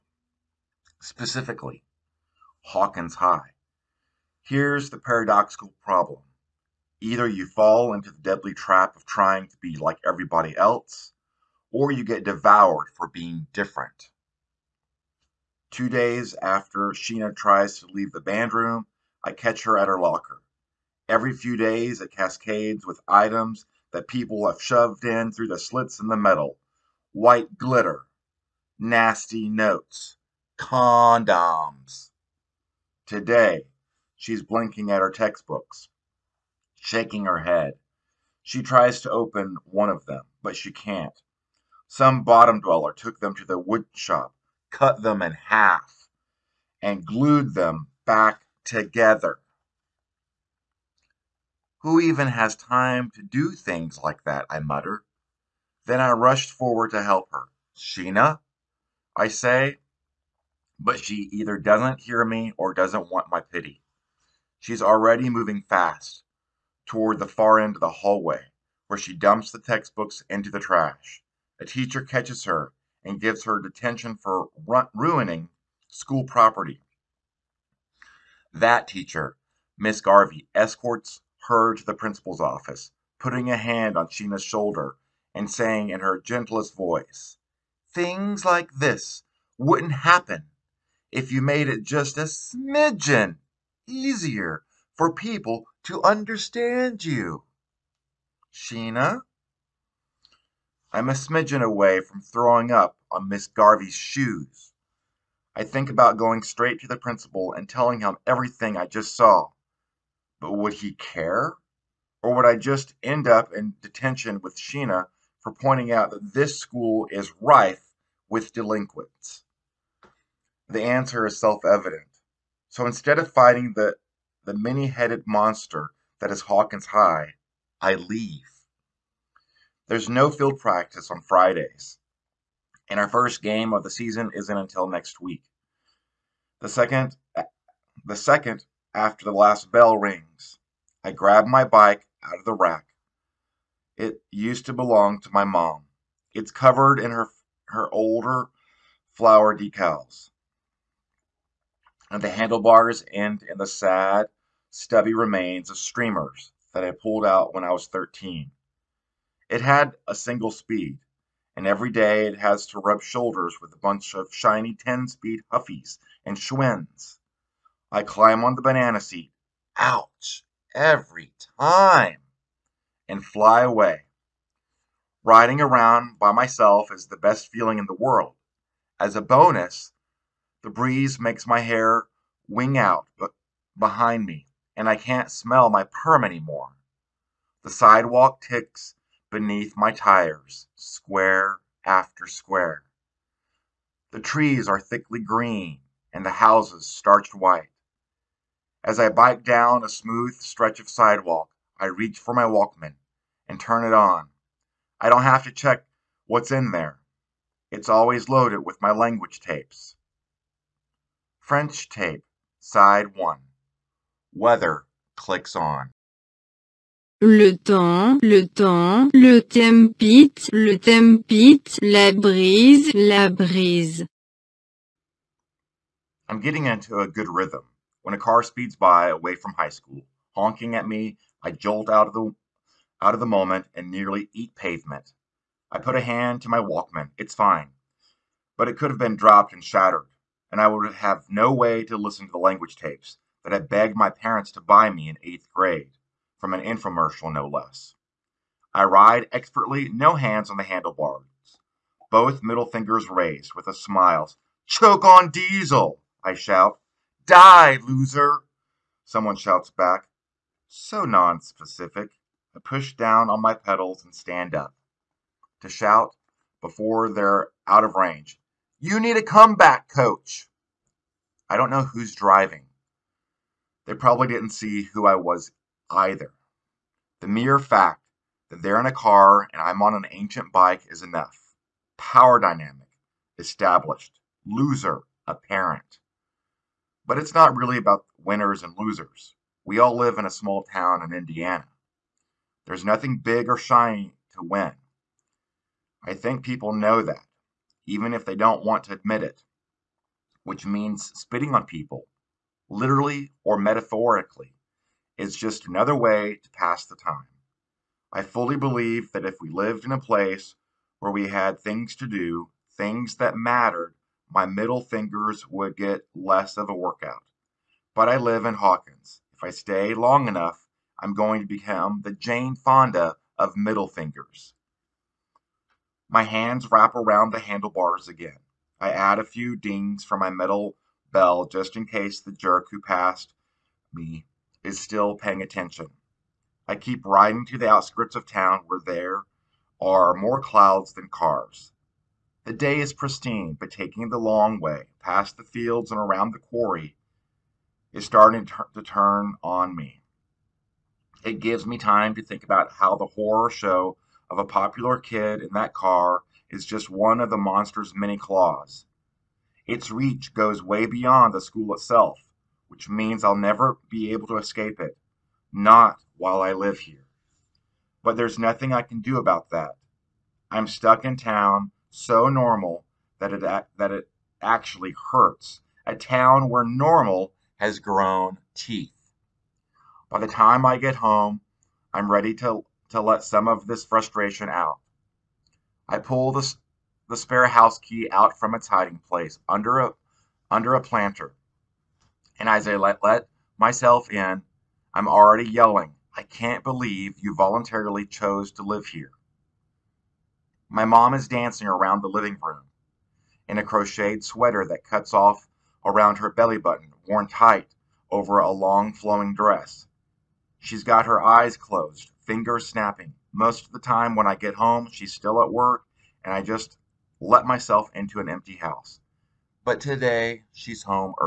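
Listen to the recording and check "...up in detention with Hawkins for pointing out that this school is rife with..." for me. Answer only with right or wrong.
wrong.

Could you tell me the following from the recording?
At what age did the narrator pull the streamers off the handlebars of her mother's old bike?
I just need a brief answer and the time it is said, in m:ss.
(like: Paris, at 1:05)
13, at 2:37.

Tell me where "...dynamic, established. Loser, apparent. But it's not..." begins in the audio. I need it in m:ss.
4:42.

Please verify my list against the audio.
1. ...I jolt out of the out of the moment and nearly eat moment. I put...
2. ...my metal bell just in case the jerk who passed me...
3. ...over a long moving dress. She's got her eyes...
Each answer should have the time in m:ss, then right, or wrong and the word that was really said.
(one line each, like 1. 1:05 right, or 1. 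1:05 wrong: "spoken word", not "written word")
1. 3:51 wrong: "pavement", not "moment"
2. 5:30 right
3. 6:48 wrong: "flowing", not "moving".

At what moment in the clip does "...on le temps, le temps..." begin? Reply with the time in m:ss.
3:35.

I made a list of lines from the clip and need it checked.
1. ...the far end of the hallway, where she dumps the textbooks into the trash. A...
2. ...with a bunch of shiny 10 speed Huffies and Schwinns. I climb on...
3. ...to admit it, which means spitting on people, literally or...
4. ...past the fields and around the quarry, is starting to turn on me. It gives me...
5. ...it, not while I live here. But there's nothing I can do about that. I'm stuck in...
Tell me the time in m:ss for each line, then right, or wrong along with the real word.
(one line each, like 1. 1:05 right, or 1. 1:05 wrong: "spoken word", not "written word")
1. 1:07 right
2. 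2:43 right
3. 4:58 right
4. 5:44 right
5. 6:04 right.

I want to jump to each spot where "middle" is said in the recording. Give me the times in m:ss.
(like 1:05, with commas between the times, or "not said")
4:12, 5:14, 5:23.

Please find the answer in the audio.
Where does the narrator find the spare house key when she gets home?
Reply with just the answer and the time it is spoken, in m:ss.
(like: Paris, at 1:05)
under a planter, at 6:30.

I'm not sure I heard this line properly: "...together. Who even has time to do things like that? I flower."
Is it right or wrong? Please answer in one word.
wrong.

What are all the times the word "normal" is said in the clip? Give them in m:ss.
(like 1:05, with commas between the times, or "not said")
6:12, 6:16.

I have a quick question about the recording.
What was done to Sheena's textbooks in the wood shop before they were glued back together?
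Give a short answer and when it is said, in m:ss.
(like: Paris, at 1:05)
cut them in half, at 0:44.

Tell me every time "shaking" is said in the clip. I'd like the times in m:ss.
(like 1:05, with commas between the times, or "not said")
0:36.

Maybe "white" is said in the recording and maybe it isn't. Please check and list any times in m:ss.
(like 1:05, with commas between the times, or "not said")
0:27, 3:17.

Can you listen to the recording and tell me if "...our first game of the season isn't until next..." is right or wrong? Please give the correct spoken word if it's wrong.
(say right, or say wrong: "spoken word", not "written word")
right.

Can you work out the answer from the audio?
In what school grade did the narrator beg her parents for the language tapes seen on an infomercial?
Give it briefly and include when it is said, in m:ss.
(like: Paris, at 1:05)
8th grade, at 4:05.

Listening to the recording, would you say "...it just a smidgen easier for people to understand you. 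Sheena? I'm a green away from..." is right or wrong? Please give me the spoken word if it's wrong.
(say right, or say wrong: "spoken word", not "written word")
wrong: "smidgen", not "green".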